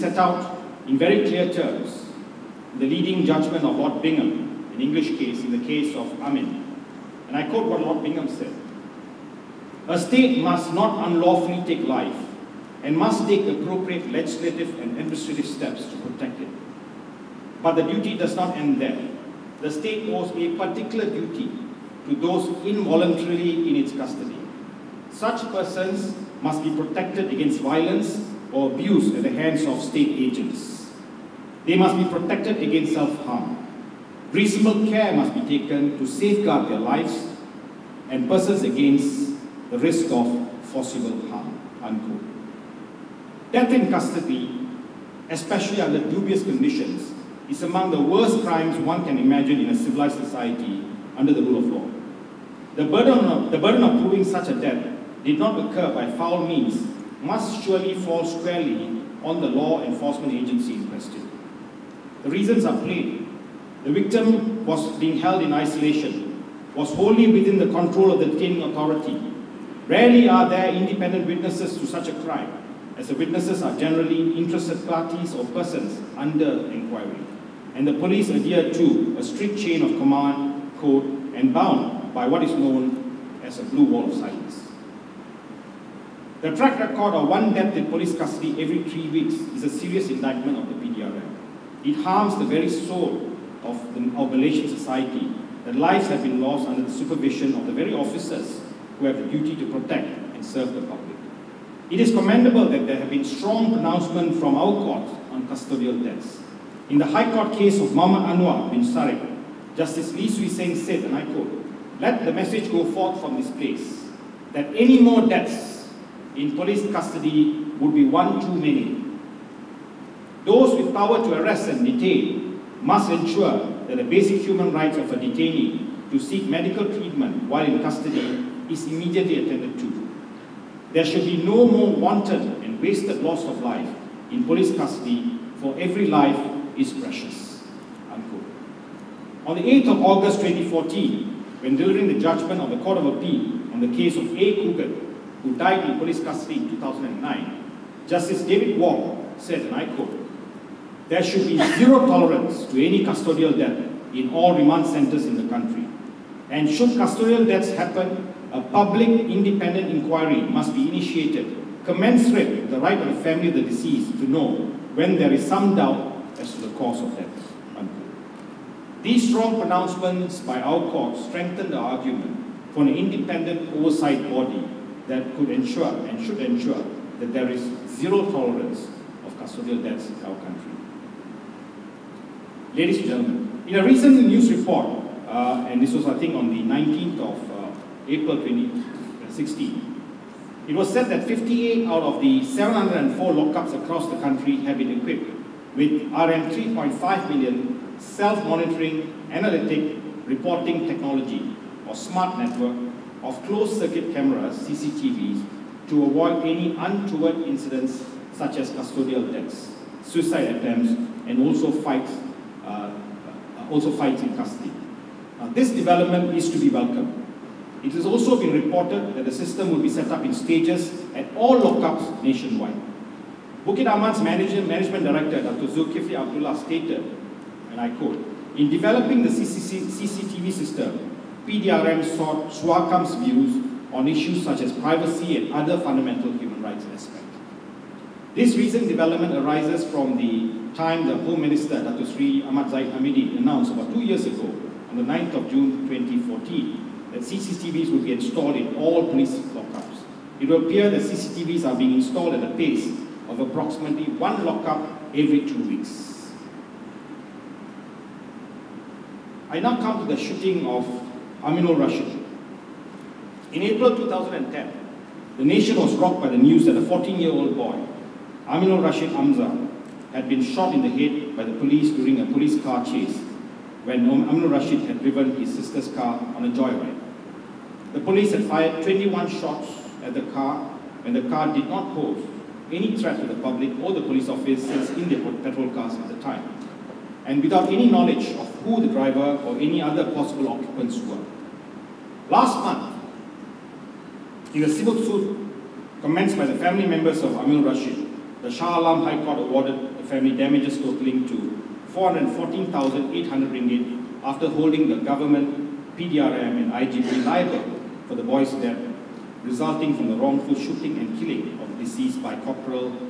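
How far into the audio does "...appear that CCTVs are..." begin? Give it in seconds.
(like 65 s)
250 s.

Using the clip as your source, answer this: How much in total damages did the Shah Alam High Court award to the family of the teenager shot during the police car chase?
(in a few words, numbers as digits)
RM414,800.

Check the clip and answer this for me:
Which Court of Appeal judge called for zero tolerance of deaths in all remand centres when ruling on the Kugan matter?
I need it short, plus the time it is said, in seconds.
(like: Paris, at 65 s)
David Wong, at 148 s.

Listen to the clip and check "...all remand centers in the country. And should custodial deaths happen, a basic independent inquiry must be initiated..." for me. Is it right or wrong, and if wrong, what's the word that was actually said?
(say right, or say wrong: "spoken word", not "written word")
wrong: "public", not "basic".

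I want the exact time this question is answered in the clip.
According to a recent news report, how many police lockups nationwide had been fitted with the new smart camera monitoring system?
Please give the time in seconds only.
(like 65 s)
191 s.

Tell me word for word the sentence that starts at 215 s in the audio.
Now, this development is to be welcomed.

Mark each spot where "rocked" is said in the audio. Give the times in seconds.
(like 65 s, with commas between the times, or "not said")
265 s.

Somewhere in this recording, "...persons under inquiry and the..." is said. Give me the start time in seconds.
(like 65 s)
75 s.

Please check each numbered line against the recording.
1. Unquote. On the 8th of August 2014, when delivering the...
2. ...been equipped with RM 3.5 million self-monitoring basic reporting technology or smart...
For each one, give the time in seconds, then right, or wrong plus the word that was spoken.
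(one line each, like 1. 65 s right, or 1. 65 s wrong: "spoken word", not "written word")
1. 138 s right
2. 194 s wrong: "analytic", not "basic".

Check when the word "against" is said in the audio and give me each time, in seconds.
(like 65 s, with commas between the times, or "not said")
27 s, 32 s, 38 s.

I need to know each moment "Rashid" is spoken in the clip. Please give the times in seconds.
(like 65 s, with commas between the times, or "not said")
261 s, 268 s, 274 s, 297 s.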